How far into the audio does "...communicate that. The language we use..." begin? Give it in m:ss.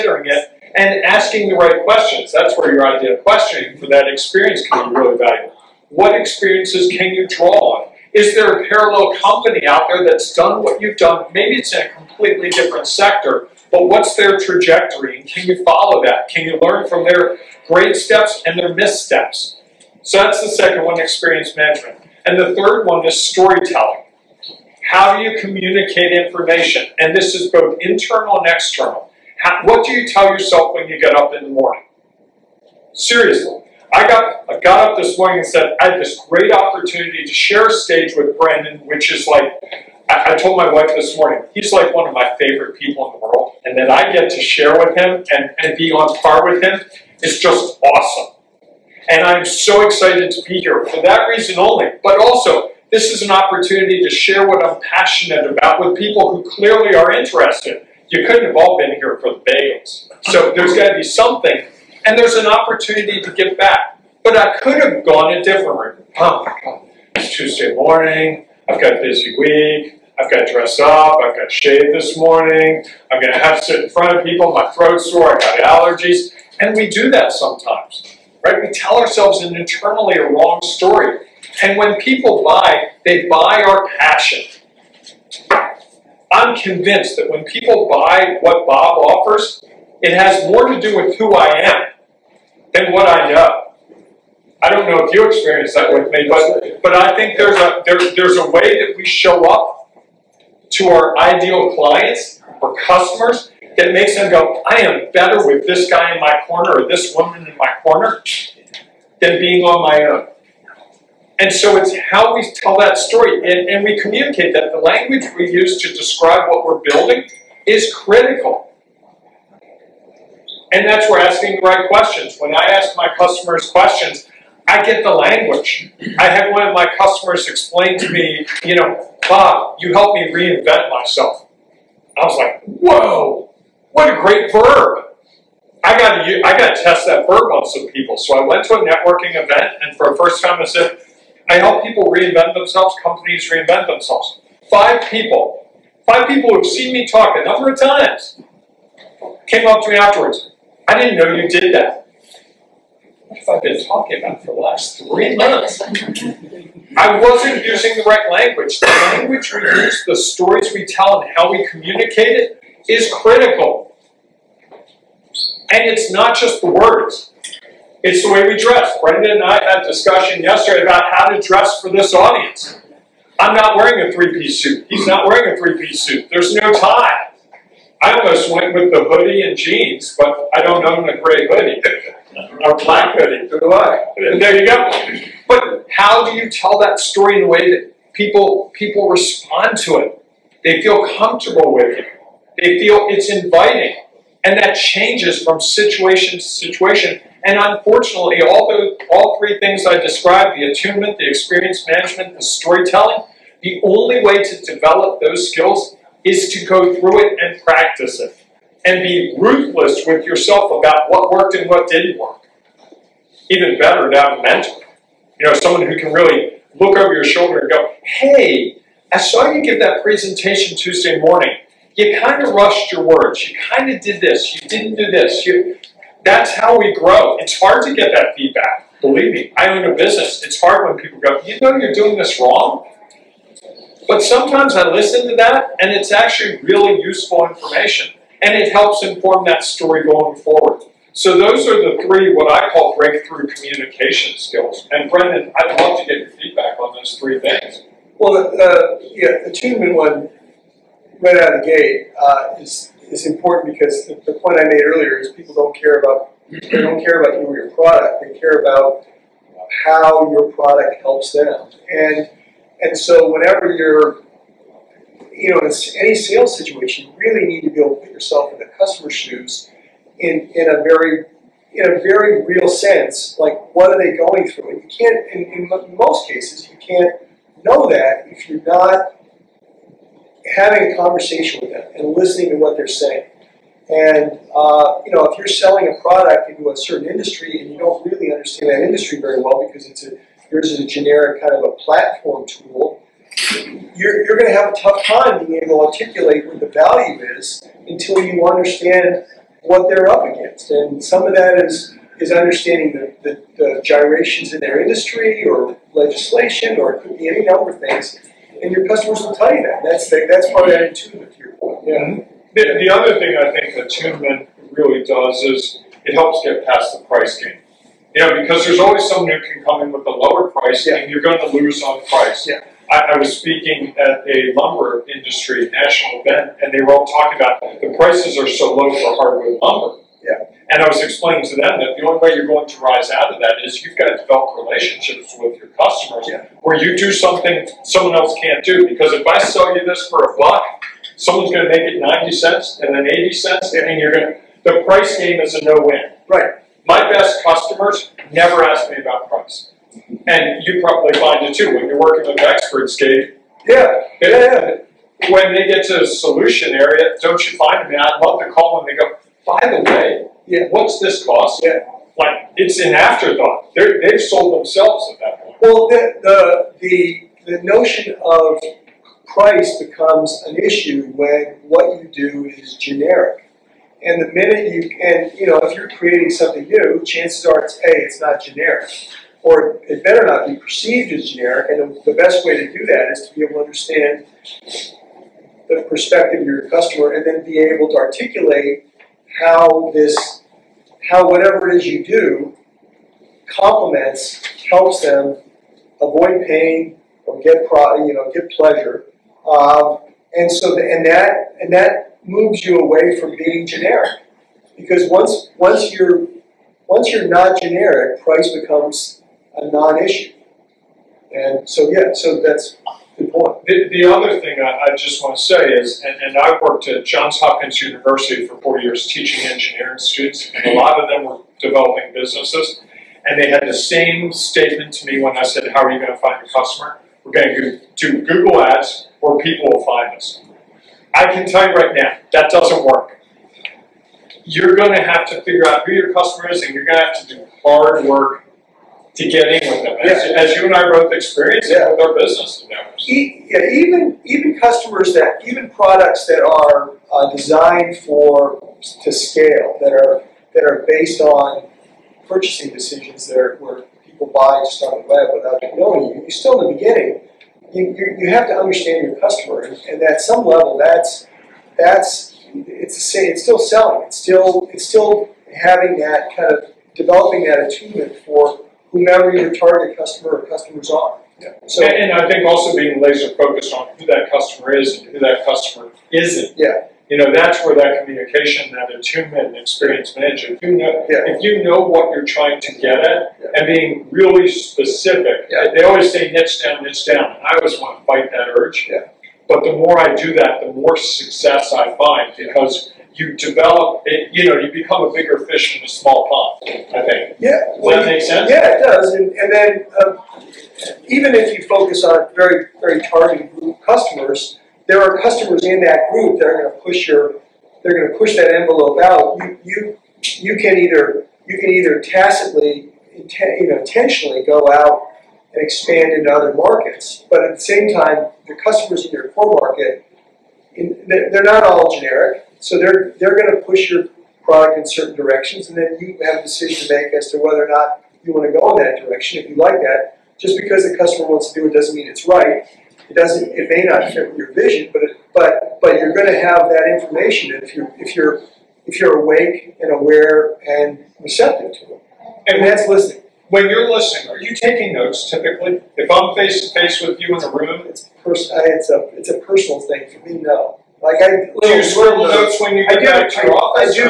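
1:53.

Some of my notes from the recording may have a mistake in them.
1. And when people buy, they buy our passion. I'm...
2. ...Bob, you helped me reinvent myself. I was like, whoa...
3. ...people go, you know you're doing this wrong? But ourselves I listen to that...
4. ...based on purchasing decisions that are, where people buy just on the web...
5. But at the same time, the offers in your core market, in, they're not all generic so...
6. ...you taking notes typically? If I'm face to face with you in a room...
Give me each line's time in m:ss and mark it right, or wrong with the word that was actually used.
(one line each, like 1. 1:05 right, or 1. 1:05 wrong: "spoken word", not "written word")
1. 1:21 right
2. 2:09 right
3. 3:51 wrong: "sometimes", not "ourselves"
4. 7:30 right
5. 8:37 wrong: "customers", not "offers"
6. 9:04 right.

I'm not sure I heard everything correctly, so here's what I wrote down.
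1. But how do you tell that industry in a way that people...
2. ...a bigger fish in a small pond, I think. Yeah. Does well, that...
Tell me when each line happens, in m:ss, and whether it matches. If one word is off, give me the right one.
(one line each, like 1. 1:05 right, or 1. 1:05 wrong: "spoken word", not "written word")
1. 3:05 wrong: "story", not "industry"
2. 8:15 right.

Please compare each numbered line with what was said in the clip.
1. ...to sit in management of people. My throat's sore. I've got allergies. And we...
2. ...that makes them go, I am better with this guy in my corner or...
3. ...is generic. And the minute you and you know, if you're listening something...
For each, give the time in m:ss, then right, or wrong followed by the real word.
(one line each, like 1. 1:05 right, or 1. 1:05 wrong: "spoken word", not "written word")
1. 1:13 wrong: "front", not "management"
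2. 1:43 right
3. 6:12 wrong: "creating", not "listening".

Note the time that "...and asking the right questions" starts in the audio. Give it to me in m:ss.
0:00.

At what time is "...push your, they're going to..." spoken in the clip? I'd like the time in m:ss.
8:26.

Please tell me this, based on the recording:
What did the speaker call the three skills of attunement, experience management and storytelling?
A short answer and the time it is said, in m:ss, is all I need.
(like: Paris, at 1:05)
Breakthrough communication skills, at 4:02.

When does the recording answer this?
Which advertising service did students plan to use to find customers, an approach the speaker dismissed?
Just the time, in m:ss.
7:08.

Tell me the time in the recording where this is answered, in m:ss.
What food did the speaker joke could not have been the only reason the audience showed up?
0:59.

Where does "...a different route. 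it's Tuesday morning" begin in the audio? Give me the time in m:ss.
1:05.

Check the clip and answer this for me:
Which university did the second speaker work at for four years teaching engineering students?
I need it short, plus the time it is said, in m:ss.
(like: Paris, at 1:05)
Johns Hopkins University, at 6:57.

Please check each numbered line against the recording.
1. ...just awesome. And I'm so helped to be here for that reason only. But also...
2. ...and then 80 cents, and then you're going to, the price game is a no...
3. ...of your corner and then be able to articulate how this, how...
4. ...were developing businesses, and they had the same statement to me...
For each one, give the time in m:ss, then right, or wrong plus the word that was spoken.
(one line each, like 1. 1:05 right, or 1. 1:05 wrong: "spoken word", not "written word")
1. 0:47 wrong: "excited", not "helped"
2. 5:42 right
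3. 6:26 wrong: "customer", not "corner"
4. 7:01 right.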